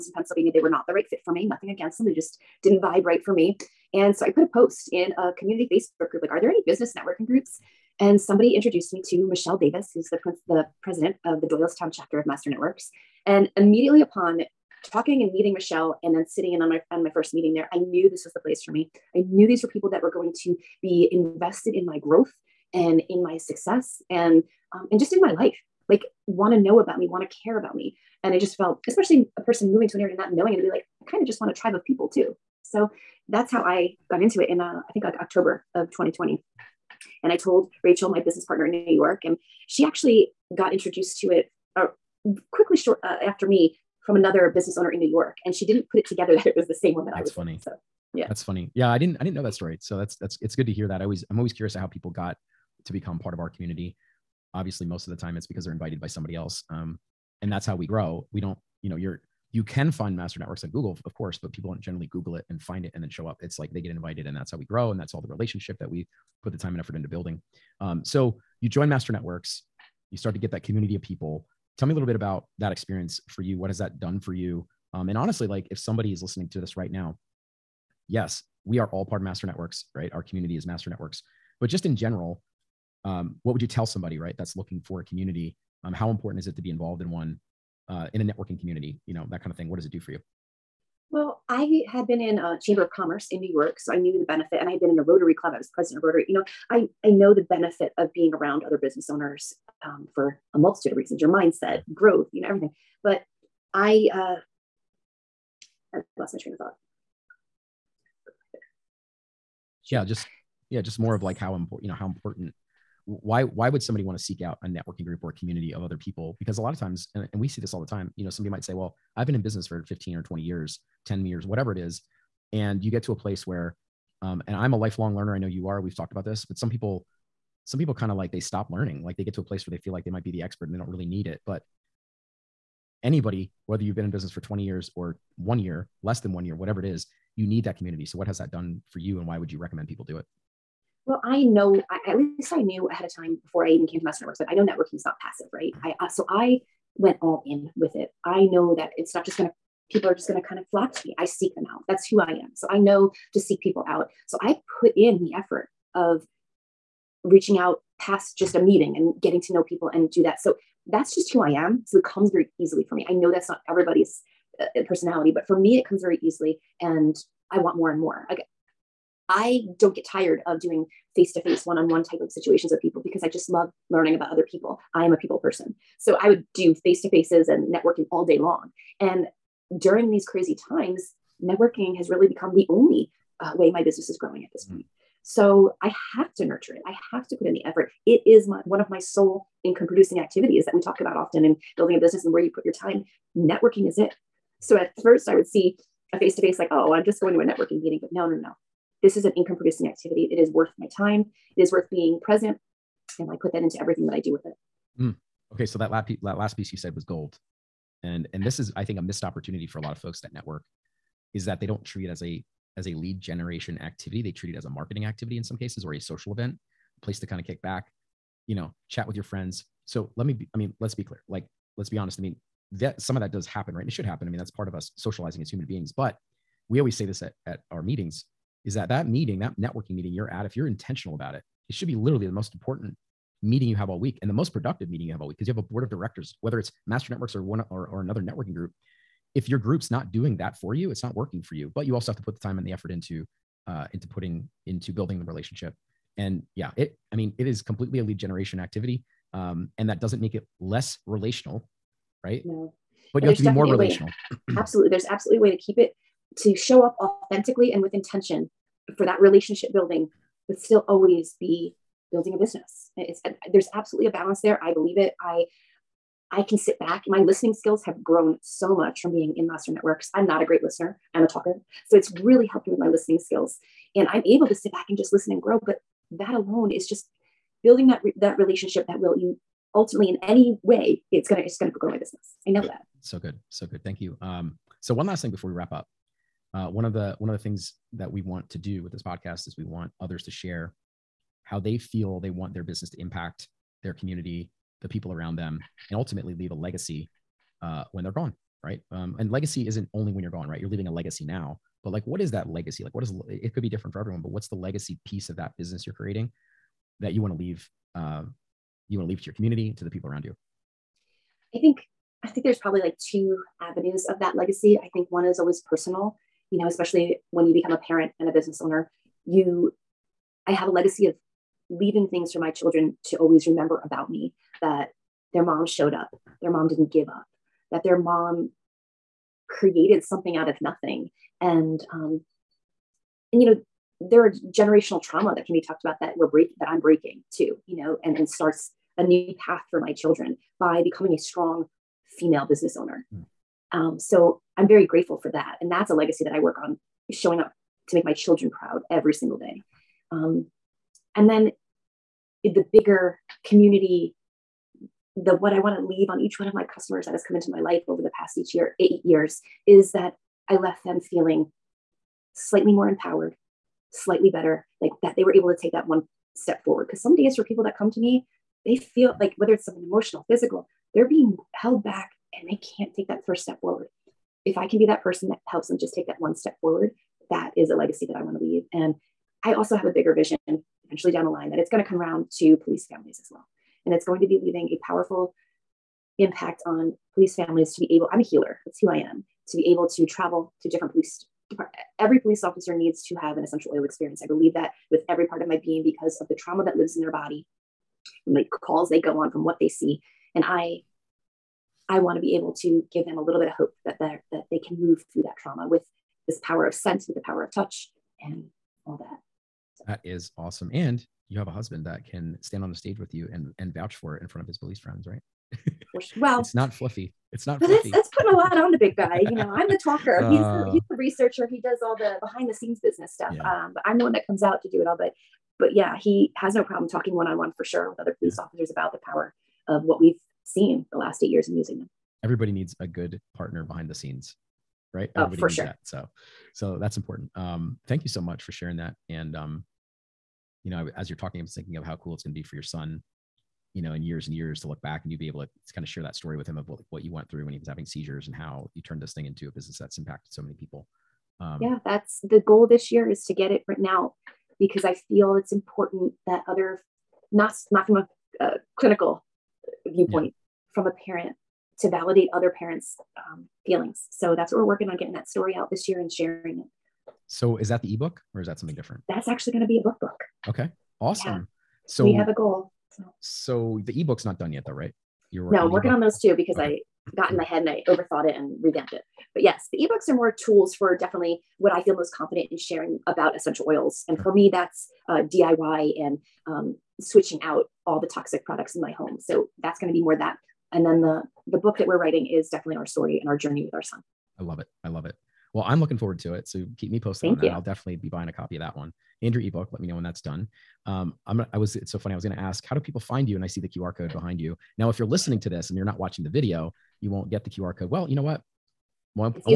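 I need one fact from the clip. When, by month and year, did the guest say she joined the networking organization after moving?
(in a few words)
October 2020.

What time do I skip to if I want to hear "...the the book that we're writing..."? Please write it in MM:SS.
08:11.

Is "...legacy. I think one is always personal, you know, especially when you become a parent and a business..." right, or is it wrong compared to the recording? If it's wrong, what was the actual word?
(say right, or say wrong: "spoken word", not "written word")
right.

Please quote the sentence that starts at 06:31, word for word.
Every police officer needs to have an essential oil experience.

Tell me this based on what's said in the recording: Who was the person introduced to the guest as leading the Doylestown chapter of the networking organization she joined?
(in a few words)
Michelle Davis.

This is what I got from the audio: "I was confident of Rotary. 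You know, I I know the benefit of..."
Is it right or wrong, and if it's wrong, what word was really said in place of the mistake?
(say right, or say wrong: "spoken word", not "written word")
wrong: "president", not "confident".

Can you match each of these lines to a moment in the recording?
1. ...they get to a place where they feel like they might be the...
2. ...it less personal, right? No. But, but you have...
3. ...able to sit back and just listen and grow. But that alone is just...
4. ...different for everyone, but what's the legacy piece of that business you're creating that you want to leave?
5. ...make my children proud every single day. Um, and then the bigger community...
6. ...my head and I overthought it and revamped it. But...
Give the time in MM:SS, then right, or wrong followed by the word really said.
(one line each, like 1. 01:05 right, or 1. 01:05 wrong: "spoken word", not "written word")
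1. 02:09 right
2. 04:10 wrong: "relational", not "personal"
3. 04:34 right
4. 05:03 right
5. 05:47 right
6. 07:57 right.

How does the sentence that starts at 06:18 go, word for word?
And I also have a bigger vision eventually down the line that it's going to come around to police families as well.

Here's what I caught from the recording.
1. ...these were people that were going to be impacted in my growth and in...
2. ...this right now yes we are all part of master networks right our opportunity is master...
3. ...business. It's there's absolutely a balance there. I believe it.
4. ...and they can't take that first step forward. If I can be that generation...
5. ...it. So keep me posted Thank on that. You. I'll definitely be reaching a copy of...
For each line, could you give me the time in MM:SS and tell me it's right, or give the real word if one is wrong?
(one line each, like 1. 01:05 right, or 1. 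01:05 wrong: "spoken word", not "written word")
1. 00:19 wrong: "invested", not "impacted"
2. 01:16 wrong: "community", not "opportunity"
3. 04:22 right
4. 06:12 wrong: "person", not "generation"
5. 08:16 wrong: "buying", not "reaching".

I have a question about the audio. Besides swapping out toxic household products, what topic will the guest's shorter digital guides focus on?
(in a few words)
DIY.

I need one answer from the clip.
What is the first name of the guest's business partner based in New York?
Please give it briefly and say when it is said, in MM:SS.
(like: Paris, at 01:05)
Rachel, at 00:37.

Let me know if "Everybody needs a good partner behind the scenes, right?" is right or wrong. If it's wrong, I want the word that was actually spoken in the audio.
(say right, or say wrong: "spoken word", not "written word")
right.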